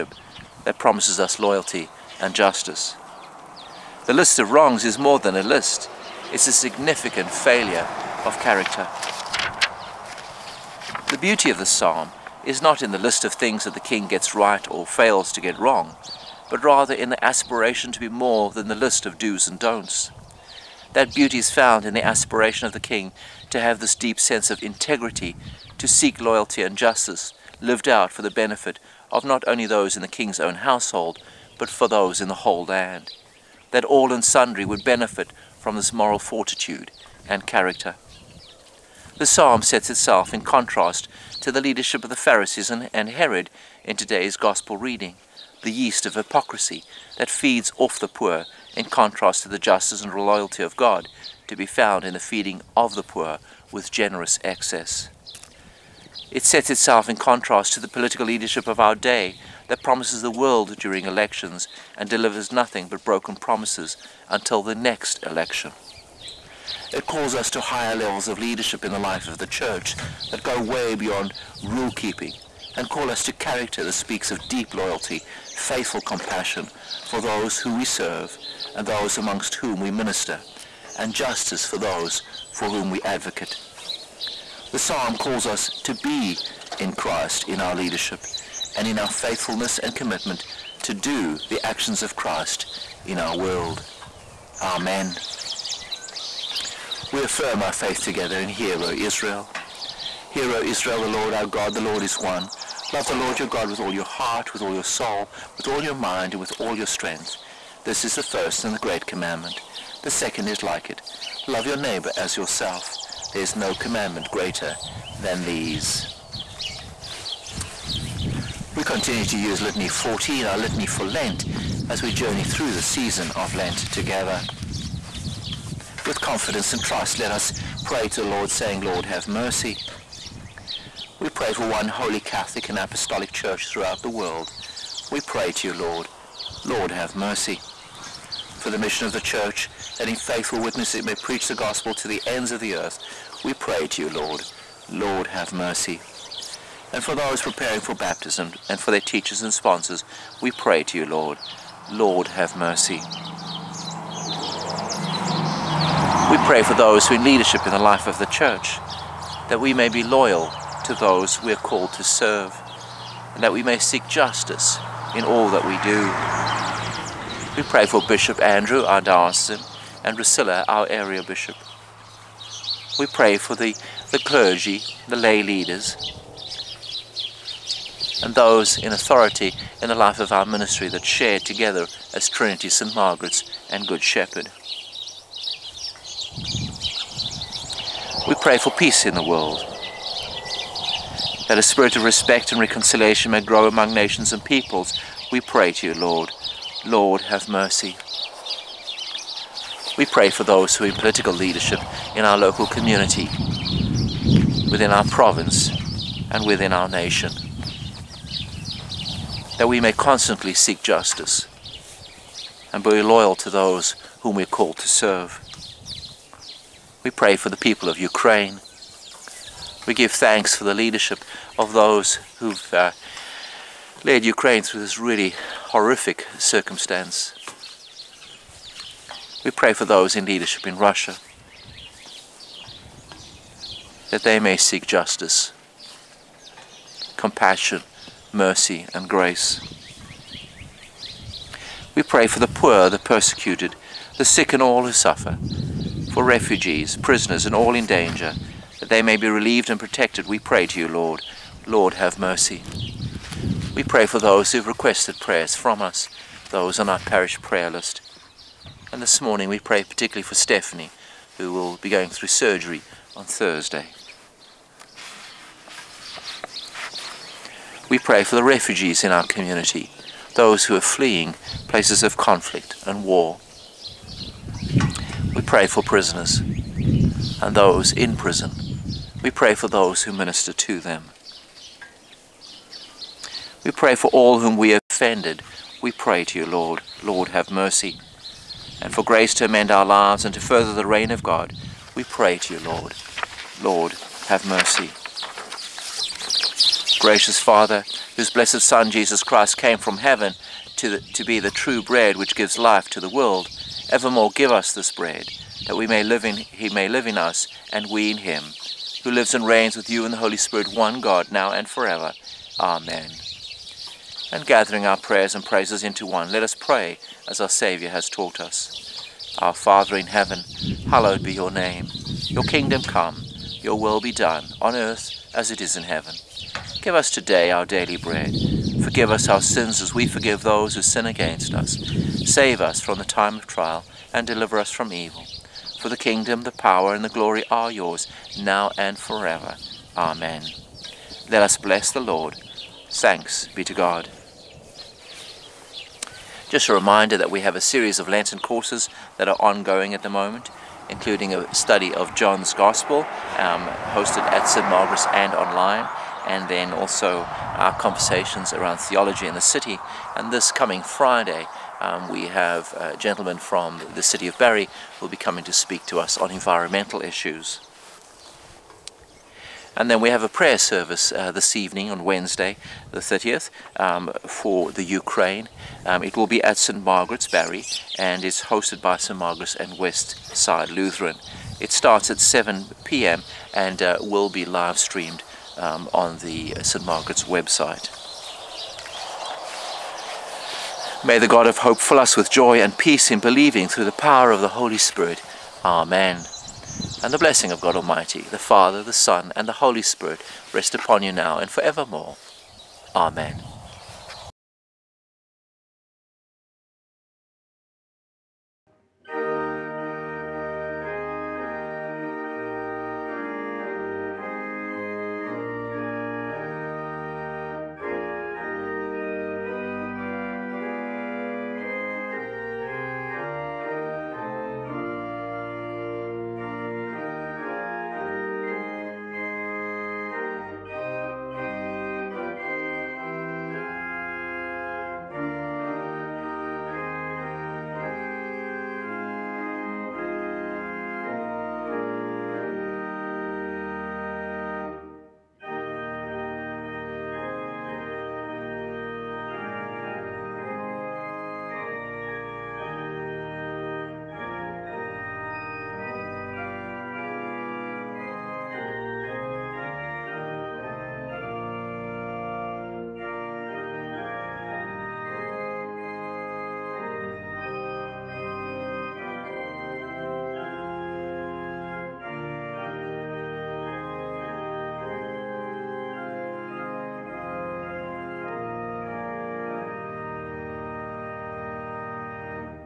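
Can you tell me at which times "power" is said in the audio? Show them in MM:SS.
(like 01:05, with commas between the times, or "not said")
05:36, 06:33.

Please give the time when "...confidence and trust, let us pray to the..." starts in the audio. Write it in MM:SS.
02:06.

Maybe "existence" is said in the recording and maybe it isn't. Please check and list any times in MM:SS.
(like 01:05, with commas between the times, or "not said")
not said.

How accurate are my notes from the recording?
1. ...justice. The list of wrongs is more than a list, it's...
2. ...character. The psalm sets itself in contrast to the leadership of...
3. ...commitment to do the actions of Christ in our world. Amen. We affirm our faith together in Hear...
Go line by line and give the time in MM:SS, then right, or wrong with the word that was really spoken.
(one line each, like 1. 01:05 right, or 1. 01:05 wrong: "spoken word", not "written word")
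1. 00:02 right
2. 00:37 right
3. 01:29 right.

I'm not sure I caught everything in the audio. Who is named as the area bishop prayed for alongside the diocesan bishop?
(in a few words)
Riscylla.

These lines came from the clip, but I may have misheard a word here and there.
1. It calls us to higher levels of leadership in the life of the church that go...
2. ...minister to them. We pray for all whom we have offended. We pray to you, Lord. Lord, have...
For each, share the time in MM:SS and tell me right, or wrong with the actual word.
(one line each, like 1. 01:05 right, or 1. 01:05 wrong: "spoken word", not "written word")
1. 01:06 right
2. 04:40 right.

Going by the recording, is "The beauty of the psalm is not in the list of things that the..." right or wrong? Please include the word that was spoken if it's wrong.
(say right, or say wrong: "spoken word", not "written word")
right.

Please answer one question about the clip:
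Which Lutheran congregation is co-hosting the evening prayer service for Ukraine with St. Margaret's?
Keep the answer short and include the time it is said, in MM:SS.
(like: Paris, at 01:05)
West Side Lutheran, at 06:19.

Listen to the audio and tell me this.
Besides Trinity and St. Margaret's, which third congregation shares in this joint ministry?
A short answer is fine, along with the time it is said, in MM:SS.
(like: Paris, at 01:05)
Good Shepherd, at 03:03.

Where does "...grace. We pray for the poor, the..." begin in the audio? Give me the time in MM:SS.
03:59.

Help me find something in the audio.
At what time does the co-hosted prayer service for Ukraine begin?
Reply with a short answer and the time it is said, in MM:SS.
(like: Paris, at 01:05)
7 p.m., at 06:22.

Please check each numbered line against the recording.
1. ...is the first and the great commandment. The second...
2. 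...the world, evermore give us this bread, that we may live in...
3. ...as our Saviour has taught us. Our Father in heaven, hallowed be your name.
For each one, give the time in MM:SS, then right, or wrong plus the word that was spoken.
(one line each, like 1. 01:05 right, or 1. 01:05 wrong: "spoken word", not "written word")
1. 01:48 right
2. 05:02 right
3. 05:17 right.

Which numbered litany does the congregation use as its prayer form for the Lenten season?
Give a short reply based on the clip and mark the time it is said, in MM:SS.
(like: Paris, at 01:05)
Litany 14, at 01:59.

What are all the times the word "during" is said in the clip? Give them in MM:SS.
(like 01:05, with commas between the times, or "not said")
01:00.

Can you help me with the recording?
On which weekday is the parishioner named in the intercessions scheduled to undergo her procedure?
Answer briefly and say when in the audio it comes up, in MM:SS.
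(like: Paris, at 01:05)
Thursday, at 04:23.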